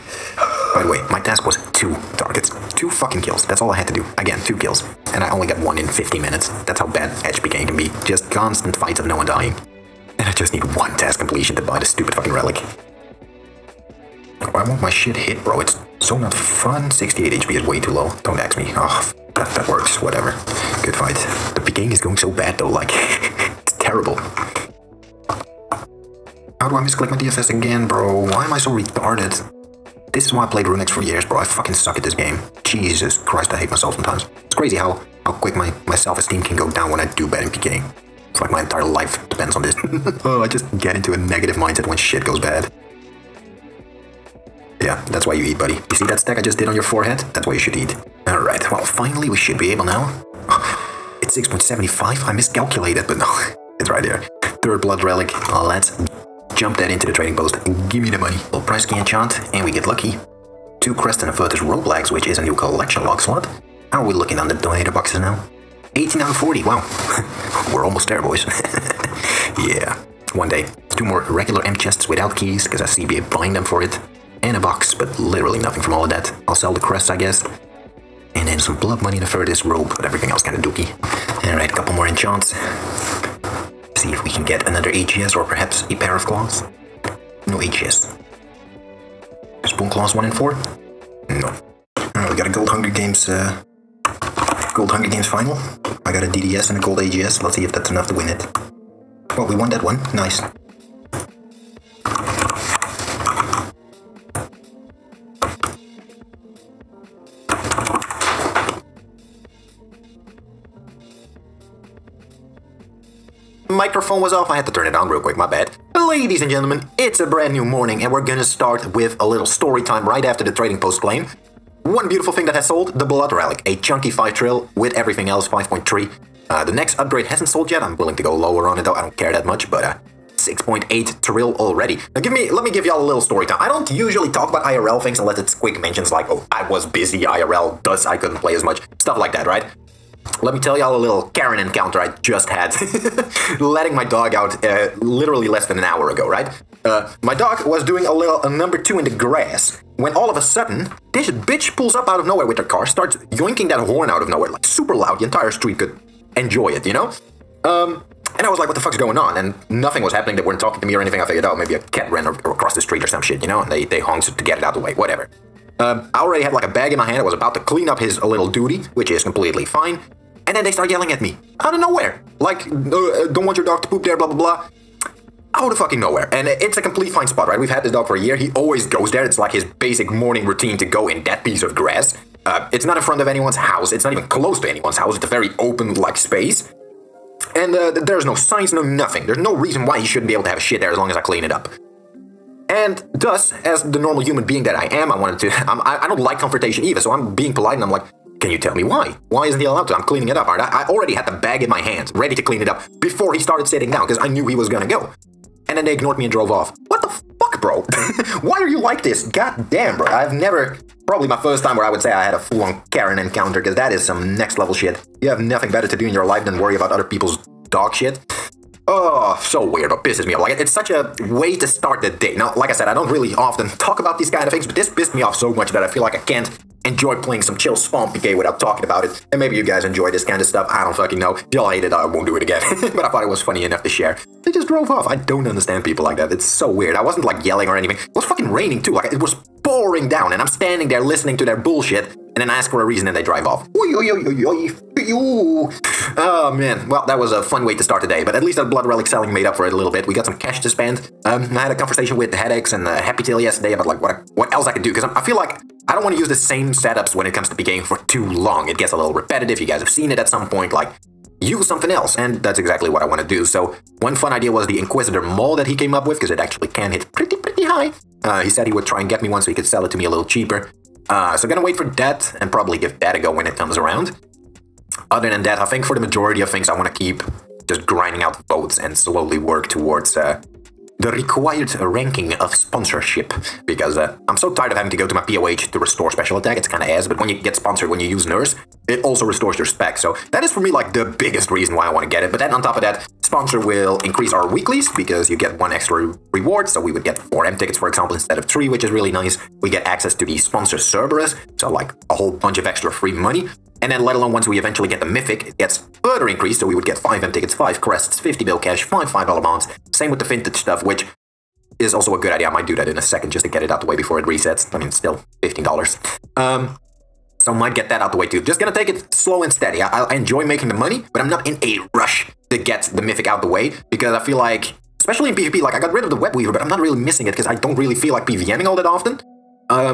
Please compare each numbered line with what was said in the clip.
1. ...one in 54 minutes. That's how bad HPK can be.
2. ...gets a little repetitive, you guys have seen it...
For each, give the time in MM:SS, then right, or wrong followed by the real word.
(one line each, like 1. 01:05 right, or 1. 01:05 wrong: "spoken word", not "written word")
1. 00:05 wrong: "50", not "54"
2. 04:18 right.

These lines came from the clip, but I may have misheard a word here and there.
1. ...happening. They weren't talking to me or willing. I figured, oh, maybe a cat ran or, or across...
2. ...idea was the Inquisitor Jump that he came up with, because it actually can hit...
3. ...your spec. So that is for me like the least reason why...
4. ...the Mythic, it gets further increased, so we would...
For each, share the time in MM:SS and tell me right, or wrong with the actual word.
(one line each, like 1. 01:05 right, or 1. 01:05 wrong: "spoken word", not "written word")
1. 02:40 wrong: "anything", not "willing"
2. 04:24 wrong: "Mole", not "Jump"
3. 04:49 wrong: "biggest", not "least"
4. 05:04 right.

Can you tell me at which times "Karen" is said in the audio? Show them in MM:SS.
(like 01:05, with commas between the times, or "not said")
02:21, 03:32.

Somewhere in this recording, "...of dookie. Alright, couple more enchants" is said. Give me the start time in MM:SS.
01:20.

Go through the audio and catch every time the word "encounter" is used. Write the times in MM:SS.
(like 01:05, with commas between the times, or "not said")
02:21, 03:33.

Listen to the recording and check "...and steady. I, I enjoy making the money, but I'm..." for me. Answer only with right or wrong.
right.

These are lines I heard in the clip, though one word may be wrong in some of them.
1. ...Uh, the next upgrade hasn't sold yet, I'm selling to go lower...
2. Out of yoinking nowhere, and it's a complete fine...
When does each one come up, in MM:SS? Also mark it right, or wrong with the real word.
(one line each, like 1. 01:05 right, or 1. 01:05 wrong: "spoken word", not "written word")
1. 02:06 wrong: "willing", not "selling"
2. 02:55 wrong: "fucking", not "yoinking".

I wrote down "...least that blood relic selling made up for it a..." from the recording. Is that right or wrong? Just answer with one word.
right.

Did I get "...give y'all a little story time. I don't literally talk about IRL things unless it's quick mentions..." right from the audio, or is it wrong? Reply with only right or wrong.
wrong.